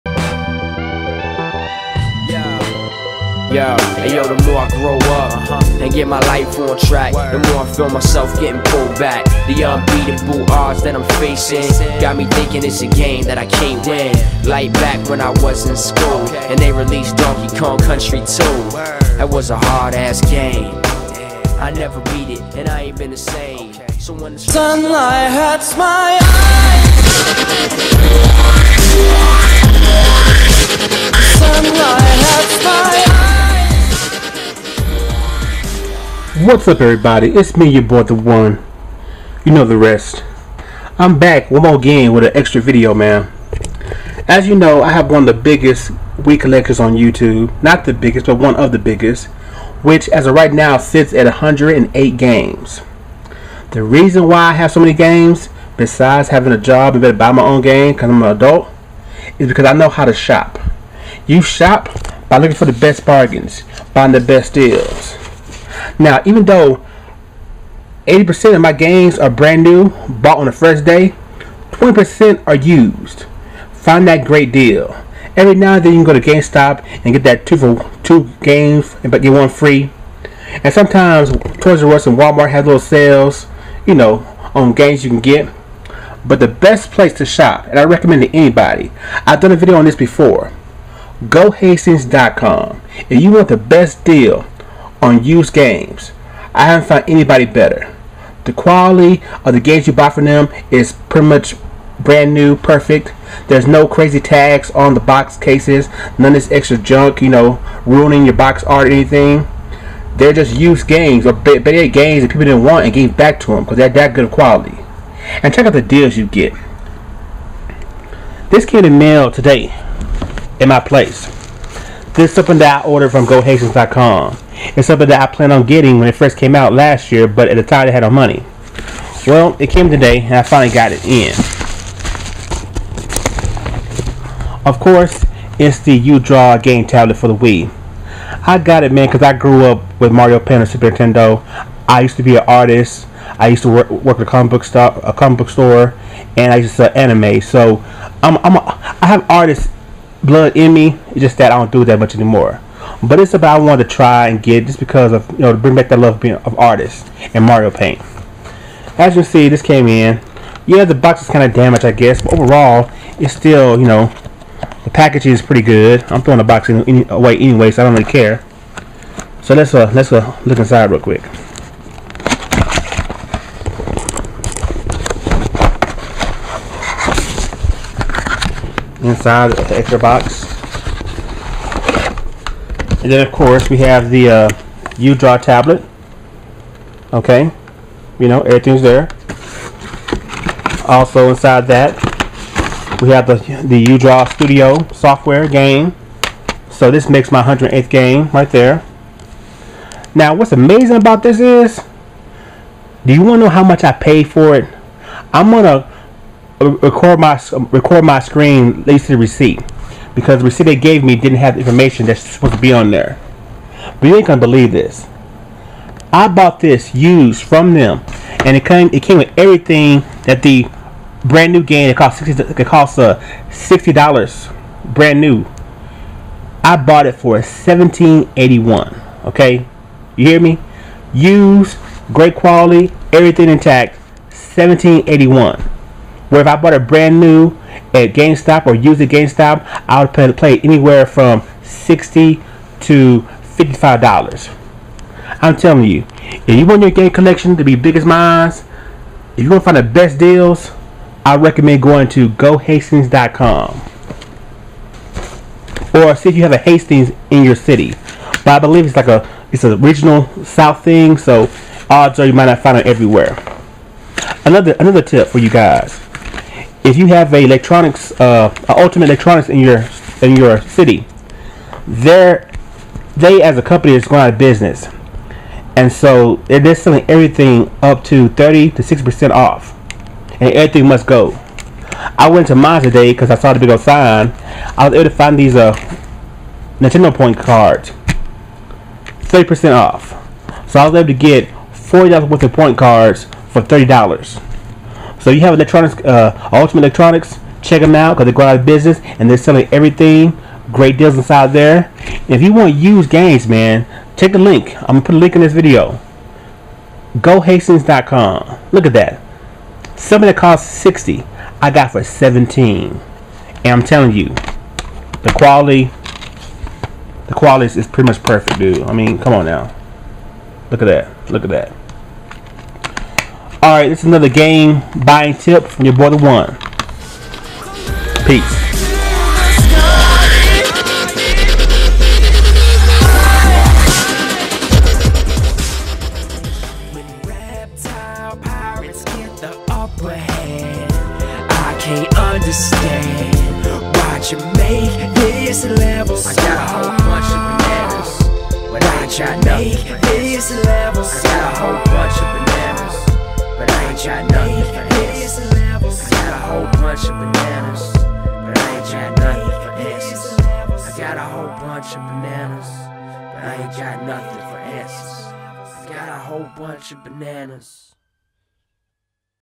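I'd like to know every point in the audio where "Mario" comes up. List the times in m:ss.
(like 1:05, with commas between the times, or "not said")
2:20, 2:37.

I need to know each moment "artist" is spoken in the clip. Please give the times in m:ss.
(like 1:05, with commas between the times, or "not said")
2:22, 2:29, 2:36.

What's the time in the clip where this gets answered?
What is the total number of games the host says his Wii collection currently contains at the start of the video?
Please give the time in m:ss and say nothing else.
0:51.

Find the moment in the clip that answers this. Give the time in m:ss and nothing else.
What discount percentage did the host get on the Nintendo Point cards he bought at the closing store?
4:49.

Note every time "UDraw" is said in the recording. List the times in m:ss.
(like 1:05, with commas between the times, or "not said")
3:04, 3:13.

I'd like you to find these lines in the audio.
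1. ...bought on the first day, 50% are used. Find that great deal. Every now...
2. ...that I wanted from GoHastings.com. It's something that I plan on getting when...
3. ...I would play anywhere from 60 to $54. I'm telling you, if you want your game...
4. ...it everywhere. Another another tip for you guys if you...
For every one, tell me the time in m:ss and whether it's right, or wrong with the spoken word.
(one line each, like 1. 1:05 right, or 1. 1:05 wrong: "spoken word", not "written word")
1. 1:10 wrong: "20", not "50"
2. 2:02 wrong: "ordered", not "wanted"
3. 3:59 wrong: "55", not "54"
4. 4:22 right.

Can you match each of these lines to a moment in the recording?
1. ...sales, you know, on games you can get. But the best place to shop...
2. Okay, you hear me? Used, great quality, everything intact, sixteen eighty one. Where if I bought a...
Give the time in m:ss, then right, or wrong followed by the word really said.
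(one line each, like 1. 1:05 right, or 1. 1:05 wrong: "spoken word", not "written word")
1. 1:22 right
2. 3:49 wrong: "seventeen", not "sixteen".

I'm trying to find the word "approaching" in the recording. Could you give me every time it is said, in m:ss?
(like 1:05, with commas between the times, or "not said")
not said.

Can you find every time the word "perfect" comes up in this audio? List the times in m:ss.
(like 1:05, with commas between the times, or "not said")
1:42, 5:18.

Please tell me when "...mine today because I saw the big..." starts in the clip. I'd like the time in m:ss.
4:42.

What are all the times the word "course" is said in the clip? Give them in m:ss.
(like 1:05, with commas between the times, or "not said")
2:14, 3:03.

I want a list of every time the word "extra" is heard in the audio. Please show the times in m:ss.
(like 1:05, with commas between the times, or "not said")
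0:42, 1:46, 2:59.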